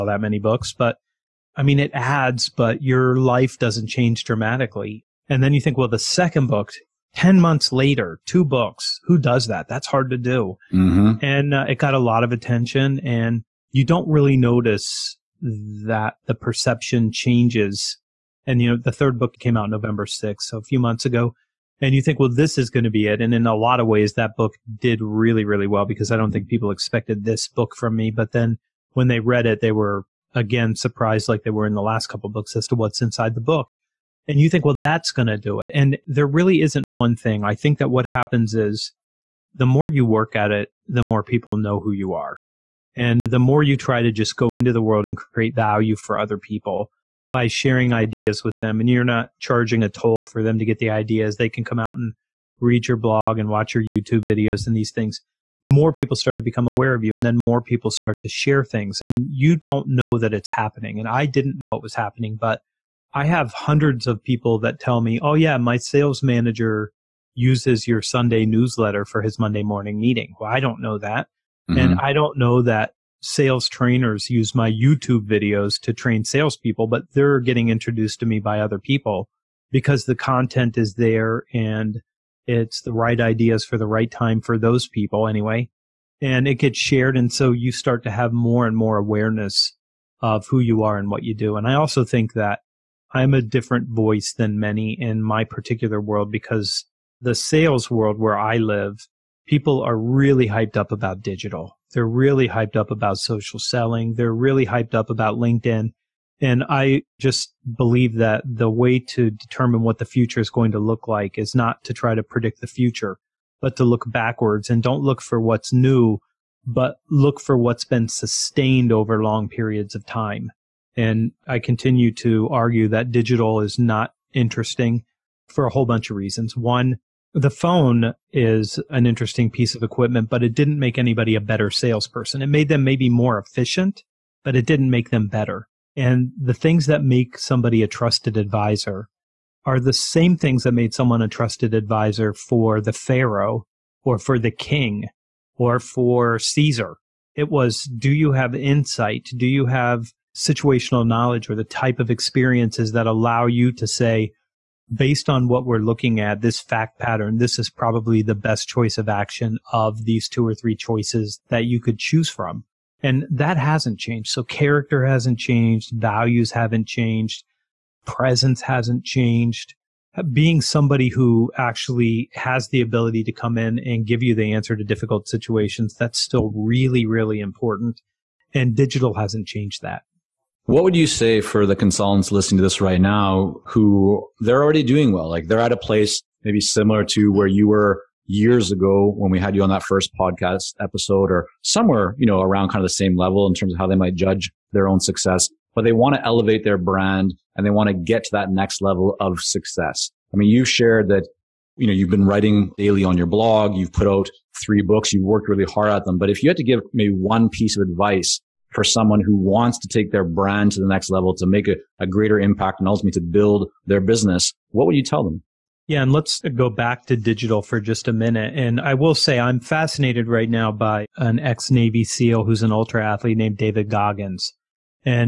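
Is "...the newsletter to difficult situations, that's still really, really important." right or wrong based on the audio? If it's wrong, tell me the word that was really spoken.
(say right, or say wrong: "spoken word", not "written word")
wrong: "answer", not "newsletter".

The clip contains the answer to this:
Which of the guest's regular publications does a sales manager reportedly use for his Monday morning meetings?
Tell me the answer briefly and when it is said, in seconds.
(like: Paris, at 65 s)
Sunday newsletter, at 68 s.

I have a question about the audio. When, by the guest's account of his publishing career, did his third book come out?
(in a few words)
November 6th.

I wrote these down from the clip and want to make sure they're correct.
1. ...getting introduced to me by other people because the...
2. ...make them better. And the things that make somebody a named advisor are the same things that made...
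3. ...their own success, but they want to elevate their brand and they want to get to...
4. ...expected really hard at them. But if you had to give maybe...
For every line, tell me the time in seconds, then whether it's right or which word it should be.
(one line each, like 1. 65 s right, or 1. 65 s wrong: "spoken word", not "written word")
1. 77 s right
2. 134 s wrong: "trusted", not "named"
3. 194 s right
4. 205 s wrong: "worked", not "expected".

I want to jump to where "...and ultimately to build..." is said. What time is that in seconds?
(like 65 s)
212 s.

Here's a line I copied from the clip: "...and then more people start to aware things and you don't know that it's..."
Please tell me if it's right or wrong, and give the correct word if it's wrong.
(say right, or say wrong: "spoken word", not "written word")
wrong: "share", not "aware".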